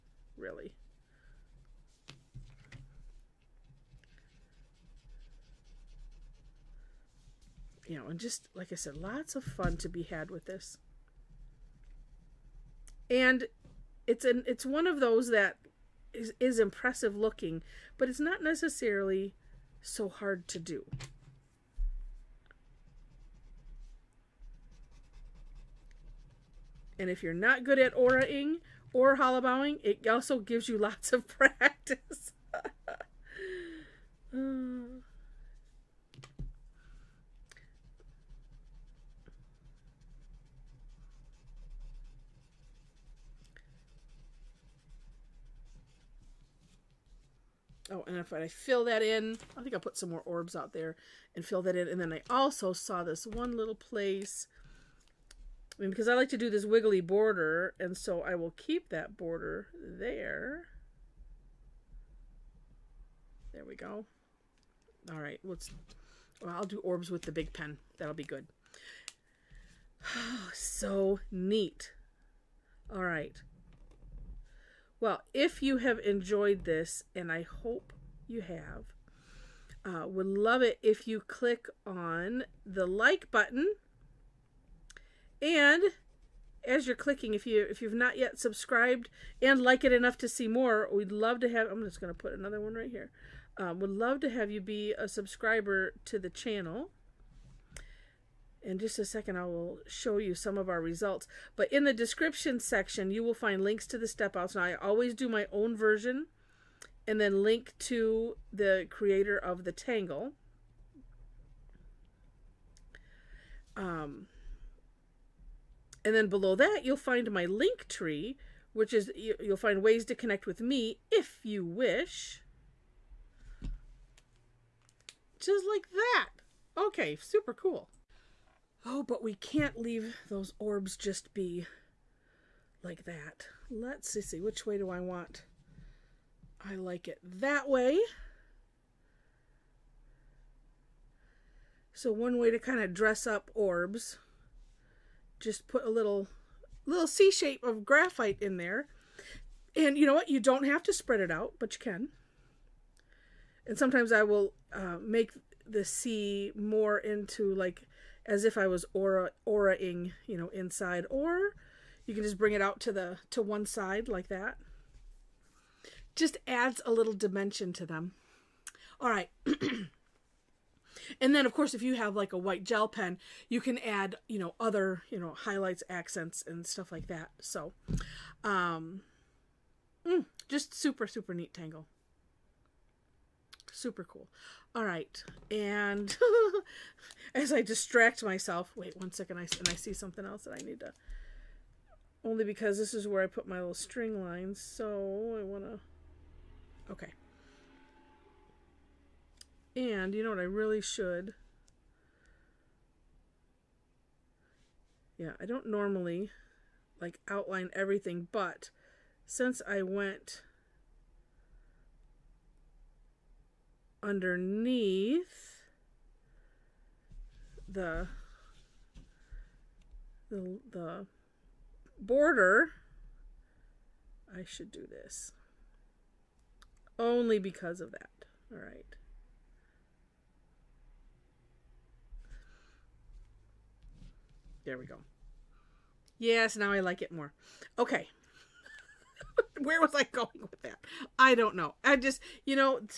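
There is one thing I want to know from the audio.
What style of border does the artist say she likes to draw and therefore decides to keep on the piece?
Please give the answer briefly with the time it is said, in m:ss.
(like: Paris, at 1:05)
Wiggly border, at 0:56.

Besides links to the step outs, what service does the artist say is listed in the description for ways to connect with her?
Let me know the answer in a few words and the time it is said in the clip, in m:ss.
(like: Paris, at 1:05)
LinkTree, at 1:57.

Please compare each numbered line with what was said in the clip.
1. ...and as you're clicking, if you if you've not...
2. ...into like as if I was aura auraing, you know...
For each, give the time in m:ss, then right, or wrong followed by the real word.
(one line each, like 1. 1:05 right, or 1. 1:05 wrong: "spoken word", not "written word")
1. 1:25 right
2. 2:36 right.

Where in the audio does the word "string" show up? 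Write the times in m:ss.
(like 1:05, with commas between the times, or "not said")
3:13.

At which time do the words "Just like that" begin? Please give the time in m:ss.
2:05.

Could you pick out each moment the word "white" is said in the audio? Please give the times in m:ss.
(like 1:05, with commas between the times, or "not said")
2:52.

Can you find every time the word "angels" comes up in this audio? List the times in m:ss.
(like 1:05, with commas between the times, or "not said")
not said.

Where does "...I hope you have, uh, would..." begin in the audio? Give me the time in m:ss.
1:17.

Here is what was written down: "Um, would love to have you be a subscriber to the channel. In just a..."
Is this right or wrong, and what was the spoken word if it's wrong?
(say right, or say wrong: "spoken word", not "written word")
right.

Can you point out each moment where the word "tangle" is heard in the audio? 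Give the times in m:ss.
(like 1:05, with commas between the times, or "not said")
1:49, 3:01.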